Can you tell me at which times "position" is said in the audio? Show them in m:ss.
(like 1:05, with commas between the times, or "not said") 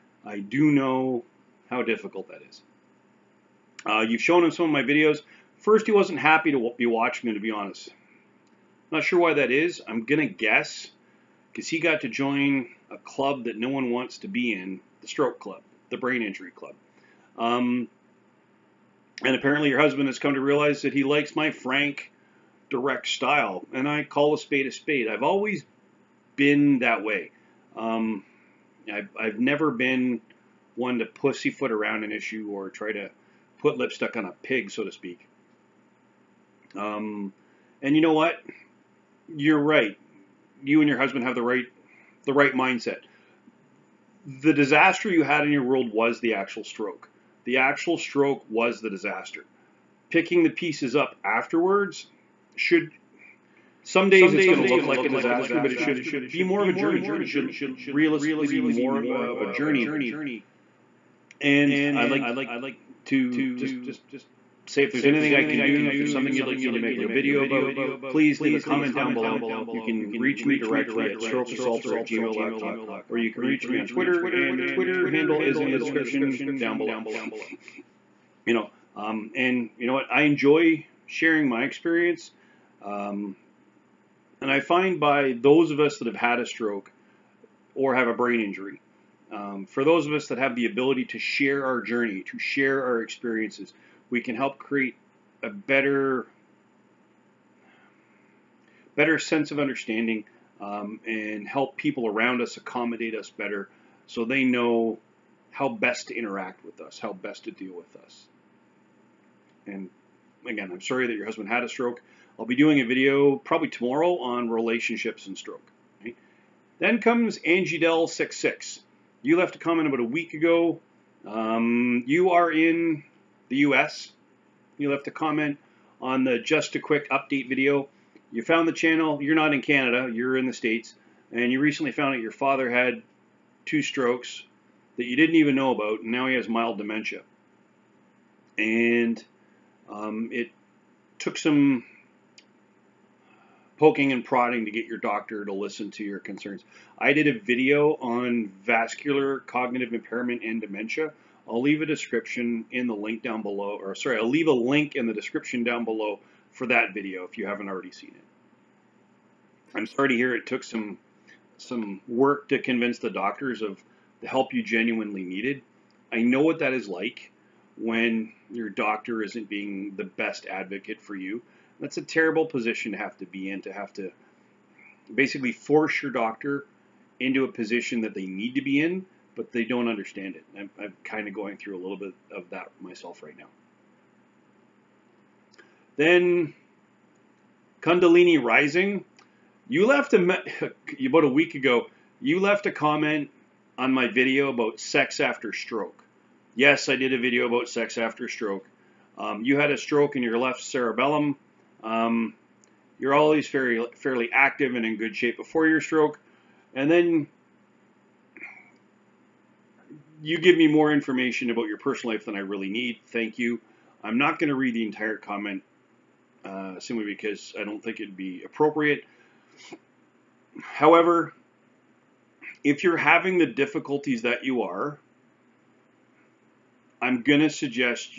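2:52, 2:57.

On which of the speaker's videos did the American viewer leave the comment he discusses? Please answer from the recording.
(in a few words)
just a quick update.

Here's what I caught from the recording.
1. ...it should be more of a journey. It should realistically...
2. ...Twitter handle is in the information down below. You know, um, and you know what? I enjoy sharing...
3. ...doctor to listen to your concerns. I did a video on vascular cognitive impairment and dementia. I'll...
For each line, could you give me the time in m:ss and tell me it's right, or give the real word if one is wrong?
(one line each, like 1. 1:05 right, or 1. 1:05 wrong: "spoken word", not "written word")
1. 0:55 right
2. 1:14 wrong: "description", not "information"
3. 2:24 right.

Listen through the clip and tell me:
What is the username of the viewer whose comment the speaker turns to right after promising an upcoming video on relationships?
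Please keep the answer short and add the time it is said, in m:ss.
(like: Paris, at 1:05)
Angie Dell 66, at 1:57.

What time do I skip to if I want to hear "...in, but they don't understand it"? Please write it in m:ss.
2:58.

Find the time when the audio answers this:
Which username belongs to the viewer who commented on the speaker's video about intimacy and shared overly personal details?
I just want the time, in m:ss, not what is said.
3:07.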